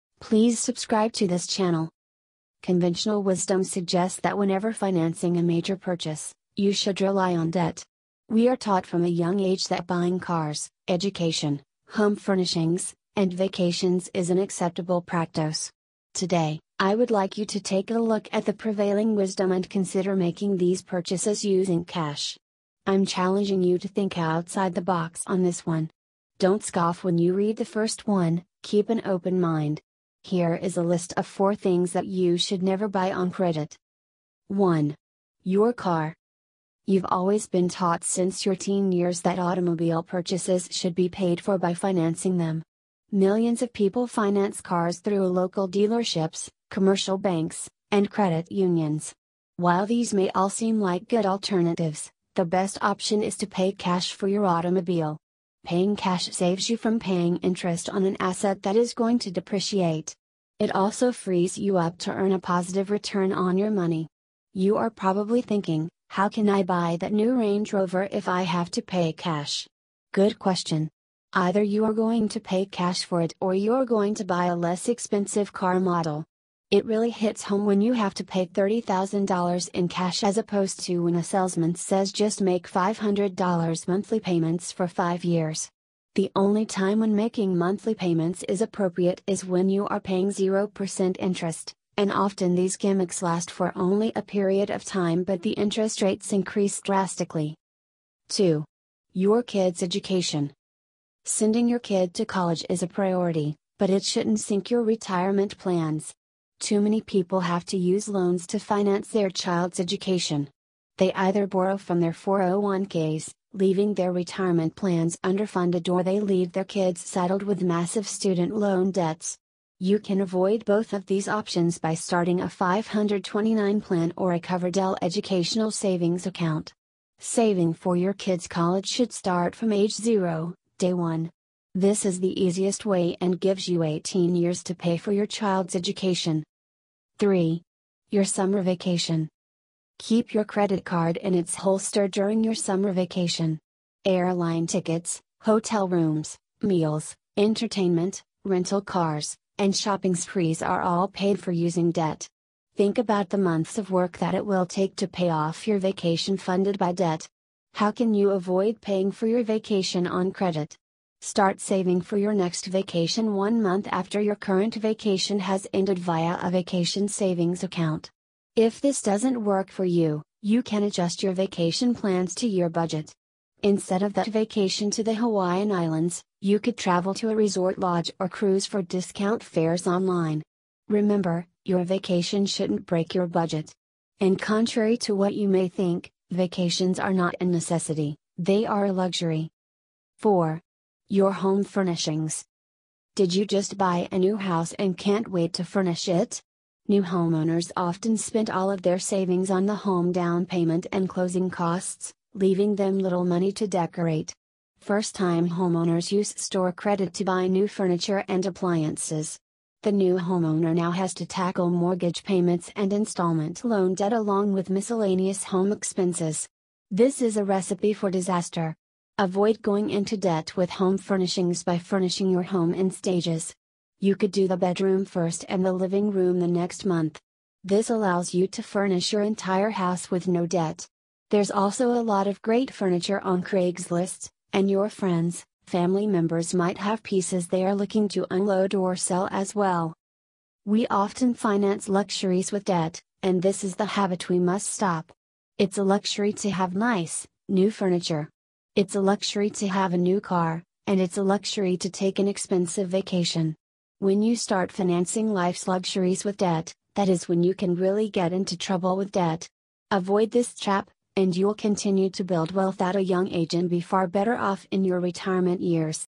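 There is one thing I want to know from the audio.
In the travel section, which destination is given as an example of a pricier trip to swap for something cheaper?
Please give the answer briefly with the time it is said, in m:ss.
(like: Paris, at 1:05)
Hawaiian Islands, at 2:55.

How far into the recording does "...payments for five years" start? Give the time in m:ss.
1:24.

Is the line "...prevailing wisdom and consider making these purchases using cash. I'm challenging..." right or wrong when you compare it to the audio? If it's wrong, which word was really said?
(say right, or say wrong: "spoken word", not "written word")
right.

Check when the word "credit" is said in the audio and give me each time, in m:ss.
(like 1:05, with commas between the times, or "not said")
0:33, 0:48, 2:20, 2:40, 3:26.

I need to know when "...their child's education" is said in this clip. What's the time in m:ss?
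1:49.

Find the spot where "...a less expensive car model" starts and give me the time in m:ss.
1:14.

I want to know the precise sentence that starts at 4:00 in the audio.
We often finance luxuries with debt, and this is the habit we must stop.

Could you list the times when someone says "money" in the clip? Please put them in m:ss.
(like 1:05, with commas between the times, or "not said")
1:03, 3:23.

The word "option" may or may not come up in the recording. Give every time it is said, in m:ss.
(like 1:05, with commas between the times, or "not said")
0:52, 2:01.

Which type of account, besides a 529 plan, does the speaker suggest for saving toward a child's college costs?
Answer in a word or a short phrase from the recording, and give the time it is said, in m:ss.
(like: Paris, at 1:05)
Coverdell educational savings account, at 2:04.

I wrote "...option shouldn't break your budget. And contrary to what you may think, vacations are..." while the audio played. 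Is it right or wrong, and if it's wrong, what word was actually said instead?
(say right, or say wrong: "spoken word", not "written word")
wrong: "vacation", not "option".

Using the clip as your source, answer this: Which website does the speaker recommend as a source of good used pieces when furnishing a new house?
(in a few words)
Craigslist.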